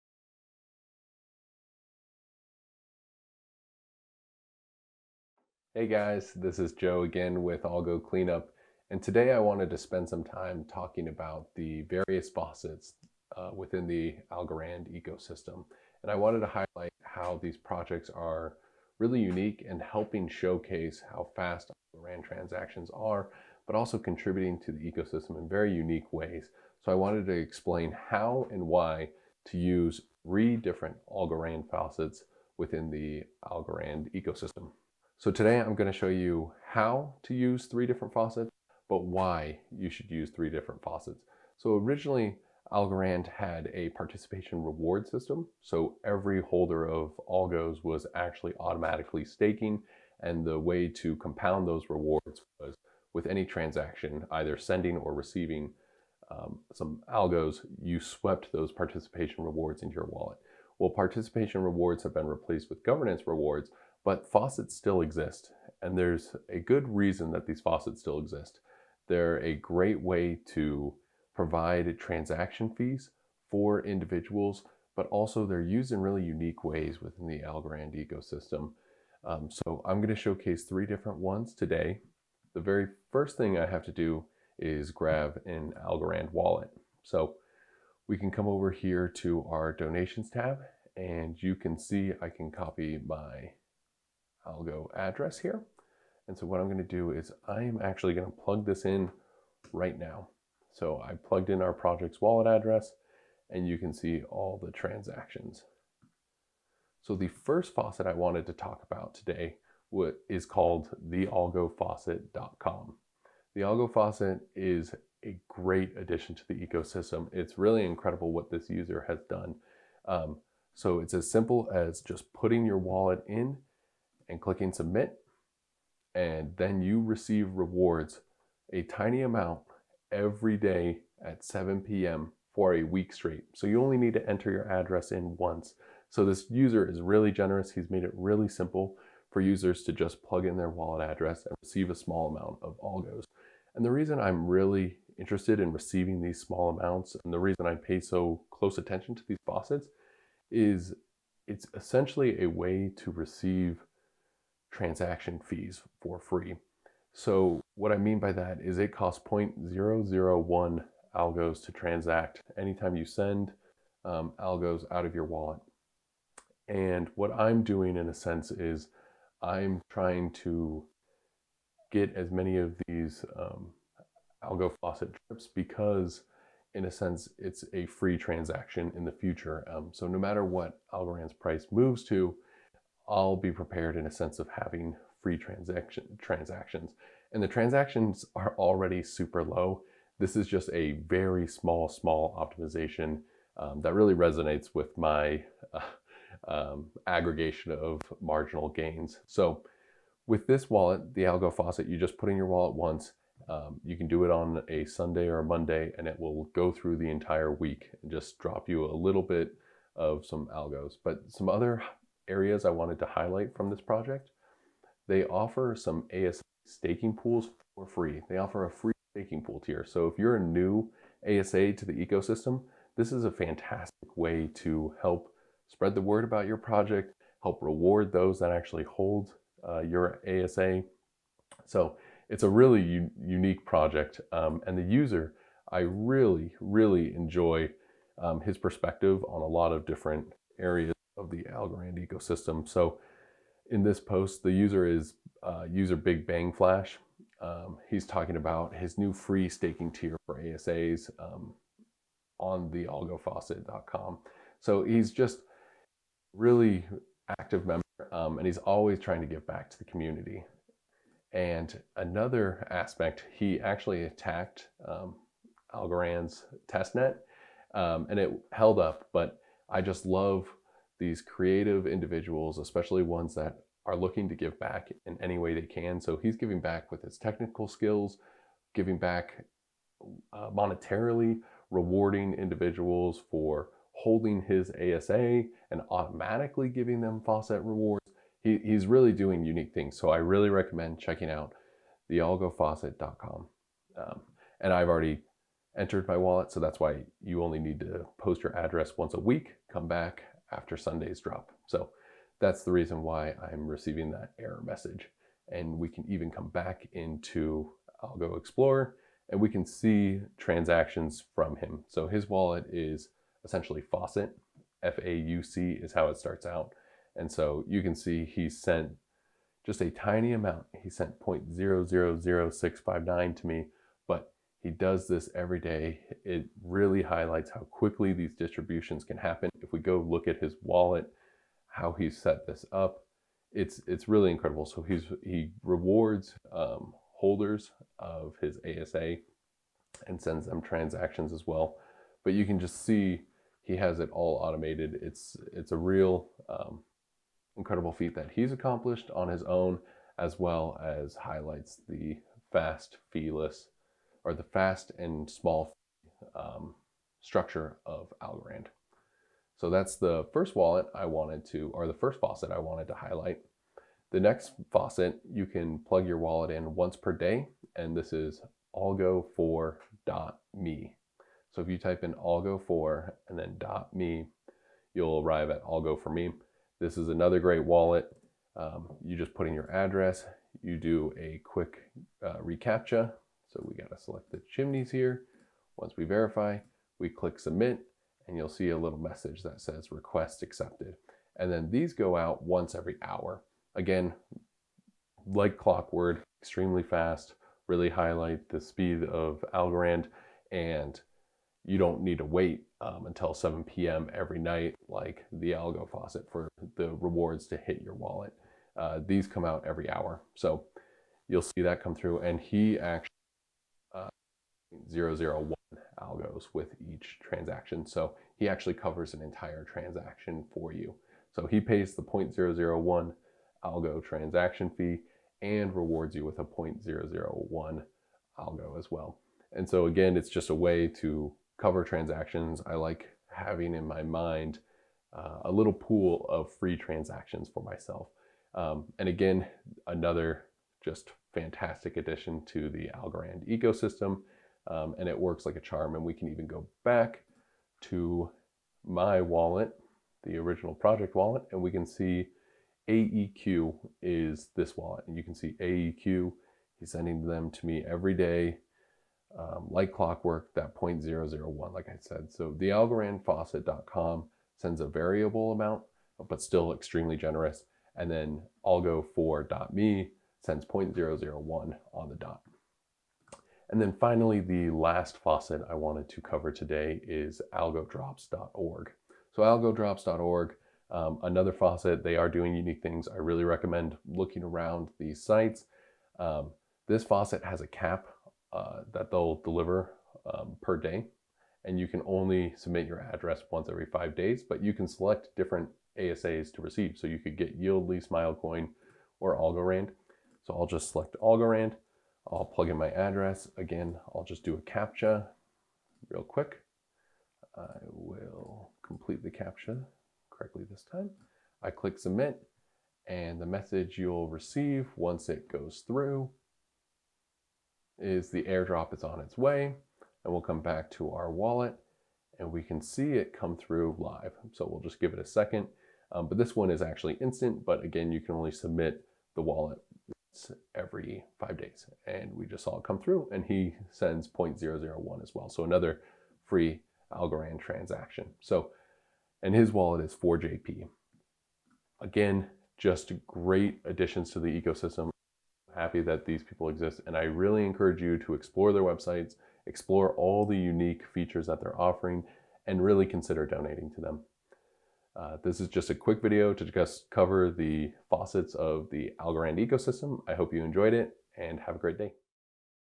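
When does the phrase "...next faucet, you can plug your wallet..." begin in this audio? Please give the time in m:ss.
6:04.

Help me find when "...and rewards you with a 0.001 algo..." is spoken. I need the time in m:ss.
7:05.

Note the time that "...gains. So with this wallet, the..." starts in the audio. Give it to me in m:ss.
3:18.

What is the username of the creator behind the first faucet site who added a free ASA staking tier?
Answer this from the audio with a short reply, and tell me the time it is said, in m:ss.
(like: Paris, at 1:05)
Big Bang Flash, at 4:05.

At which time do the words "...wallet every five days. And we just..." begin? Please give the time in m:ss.
8:49.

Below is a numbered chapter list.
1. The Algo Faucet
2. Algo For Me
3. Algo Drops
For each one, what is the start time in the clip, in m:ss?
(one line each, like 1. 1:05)
1. 1:47
2. 6:02
3. 7:52.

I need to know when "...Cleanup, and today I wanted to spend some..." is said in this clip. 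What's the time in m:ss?
0:08.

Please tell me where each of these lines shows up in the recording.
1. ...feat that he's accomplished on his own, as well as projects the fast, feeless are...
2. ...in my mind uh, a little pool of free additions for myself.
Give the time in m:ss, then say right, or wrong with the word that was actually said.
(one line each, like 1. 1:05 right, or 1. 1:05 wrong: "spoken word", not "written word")
1. 5:47 wrong: "highlights", not "projects"
2. 7:13 wrong: "transactions", not "additions".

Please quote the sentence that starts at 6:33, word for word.
Again, like clockwork, extremely fast, really highlight the speed of Algorand and you don't need to wait um, until 7 p.m.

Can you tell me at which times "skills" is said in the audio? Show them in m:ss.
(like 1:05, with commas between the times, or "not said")
4:37.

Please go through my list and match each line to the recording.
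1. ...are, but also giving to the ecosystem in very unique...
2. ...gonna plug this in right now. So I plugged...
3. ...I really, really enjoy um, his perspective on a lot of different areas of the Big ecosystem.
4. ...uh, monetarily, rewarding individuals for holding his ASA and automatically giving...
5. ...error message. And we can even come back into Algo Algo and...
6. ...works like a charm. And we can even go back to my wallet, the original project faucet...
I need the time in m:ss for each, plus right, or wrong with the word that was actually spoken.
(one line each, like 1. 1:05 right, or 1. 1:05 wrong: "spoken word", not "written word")
1. 0:22 wrong: "contributing", not "giving"
2. 1:38 right
3. 3:55 wrong: "Algorand", not "Big"
4. 4:40 right
5. 5:04 wrong: "Explorer", not "Algo"
6. 7:25 wrong: "wallet", not "faucet".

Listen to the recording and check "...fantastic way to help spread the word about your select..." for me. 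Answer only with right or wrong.
wrong.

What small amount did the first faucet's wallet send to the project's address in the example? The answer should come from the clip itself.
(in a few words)
0.000659.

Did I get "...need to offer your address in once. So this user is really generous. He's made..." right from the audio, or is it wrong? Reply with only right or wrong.
wrong.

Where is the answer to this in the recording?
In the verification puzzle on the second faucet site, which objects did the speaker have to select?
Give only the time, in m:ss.
6:24.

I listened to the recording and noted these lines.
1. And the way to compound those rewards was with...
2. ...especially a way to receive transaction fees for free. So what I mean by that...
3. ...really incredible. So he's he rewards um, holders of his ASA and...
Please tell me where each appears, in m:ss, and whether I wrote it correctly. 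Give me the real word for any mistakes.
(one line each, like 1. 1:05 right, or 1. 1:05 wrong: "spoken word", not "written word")
1. 0:50 right
2. 2:31 wrong: "essentially", not "especially"
3. 5:34 right.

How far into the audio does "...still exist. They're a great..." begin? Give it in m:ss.
1:08.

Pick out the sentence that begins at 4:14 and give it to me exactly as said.
So he's just really active member um, and he's always trying to give back to the community.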